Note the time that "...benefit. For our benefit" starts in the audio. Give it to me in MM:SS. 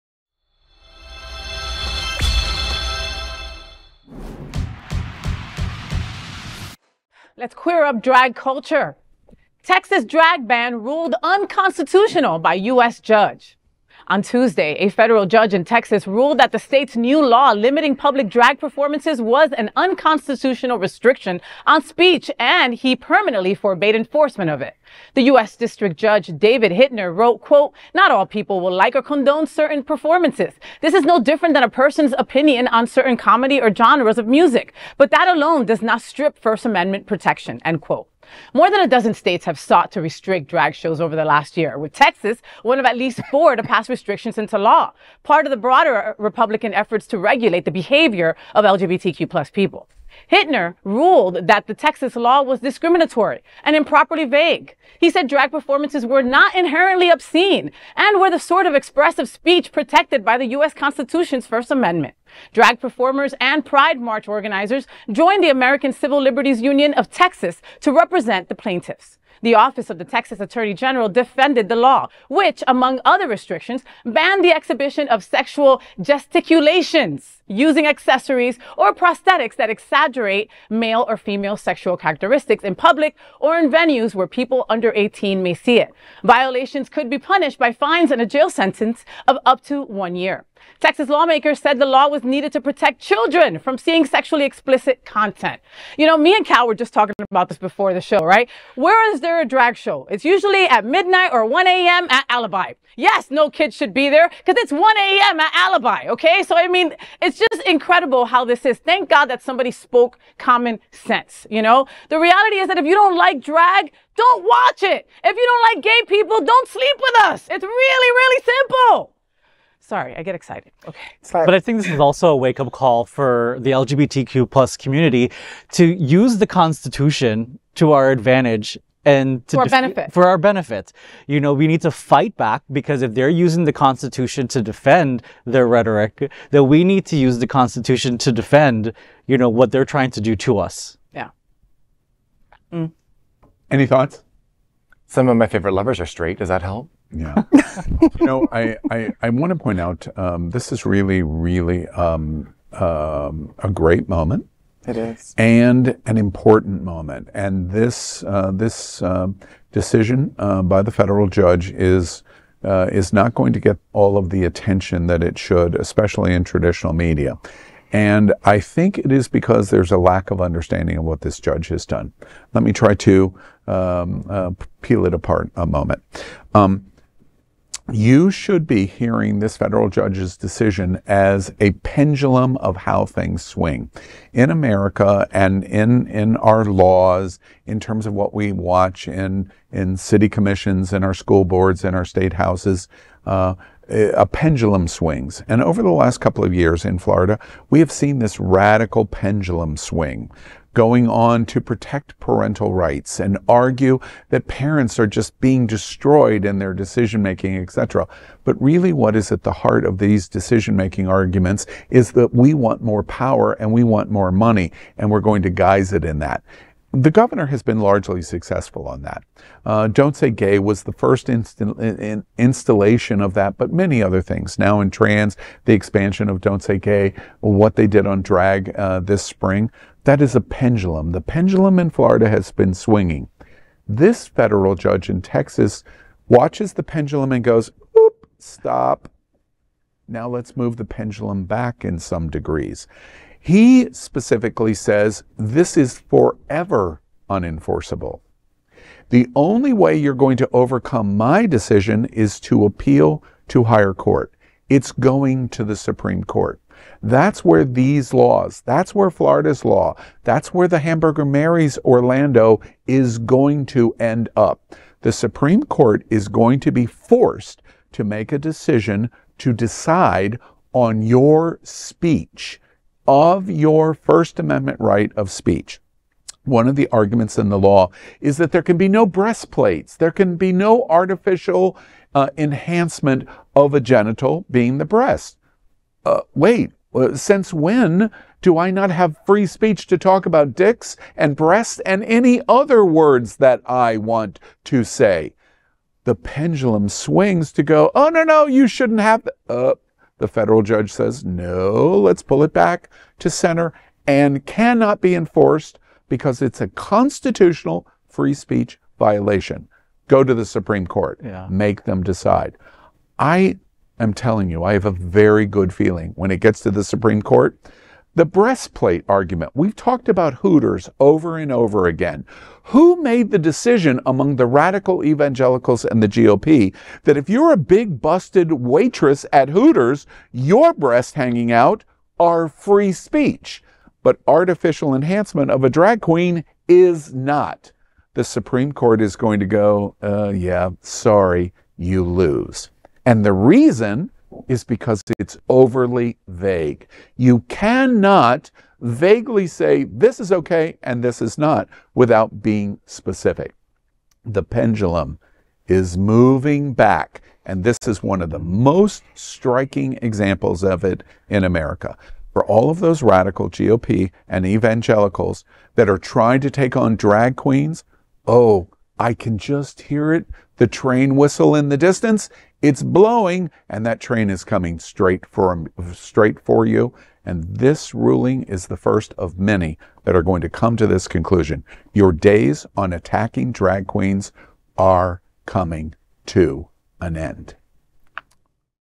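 02:09.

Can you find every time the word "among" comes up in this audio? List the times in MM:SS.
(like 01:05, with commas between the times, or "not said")
01:12, 05:24.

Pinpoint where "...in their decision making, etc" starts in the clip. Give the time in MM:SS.
03:26.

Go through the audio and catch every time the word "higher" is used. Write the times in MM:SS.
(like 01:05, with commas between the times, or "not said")
04:13.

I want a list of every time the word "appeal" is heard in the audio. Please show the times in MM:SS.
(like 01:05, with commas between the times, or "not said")
04:12.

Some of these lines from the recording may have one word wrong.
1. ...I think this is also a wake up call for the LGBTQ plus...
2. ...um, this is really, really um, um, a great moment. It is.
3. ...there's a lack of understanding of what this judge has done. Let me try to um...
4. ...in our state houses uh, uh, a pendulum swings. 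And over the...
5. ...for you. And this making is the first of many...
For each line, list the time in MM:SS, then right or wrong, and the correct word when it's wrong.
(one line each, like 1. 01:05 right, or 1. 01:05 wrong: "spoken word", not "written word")
1. 02:01 right
2. 02:30 right
3. 02:49 right
4. 03:11 right
5. 06:16 wrong: "ruling", not "making".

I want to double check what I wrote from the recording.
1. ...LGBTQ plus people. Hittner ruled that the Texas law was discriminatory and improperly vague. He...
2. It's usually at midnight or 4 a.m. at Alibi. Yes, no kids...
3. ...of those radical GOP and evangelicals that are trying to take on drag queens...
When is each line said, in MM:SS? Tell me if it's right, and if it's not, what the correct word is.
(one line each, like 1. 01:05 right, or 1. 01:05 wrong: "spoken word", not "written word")
1. 00:48 right
2. 01:40 wrong: "1", not "4"
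3. 06:02 right.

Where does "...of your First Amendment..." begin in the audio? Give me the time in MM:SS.
04:33.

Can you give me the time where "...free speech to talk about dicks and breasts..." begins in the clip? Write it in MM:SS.
04:49.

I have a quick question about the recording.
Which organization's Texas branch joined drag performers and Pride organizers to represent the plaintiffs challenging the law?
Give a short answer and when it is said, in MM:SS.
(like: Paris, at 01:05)
American Civil Liberties Union, at 01:05.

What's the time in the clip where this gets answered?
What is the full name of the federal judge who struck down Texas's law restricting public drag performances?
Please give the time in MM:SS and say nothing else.
00:26.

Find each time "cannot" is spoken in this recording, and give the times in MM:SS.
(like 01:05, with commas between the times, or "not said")
05:04, 05:47.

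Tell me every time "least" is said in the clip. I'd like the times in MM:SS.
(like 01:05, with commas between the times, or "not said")
00:42.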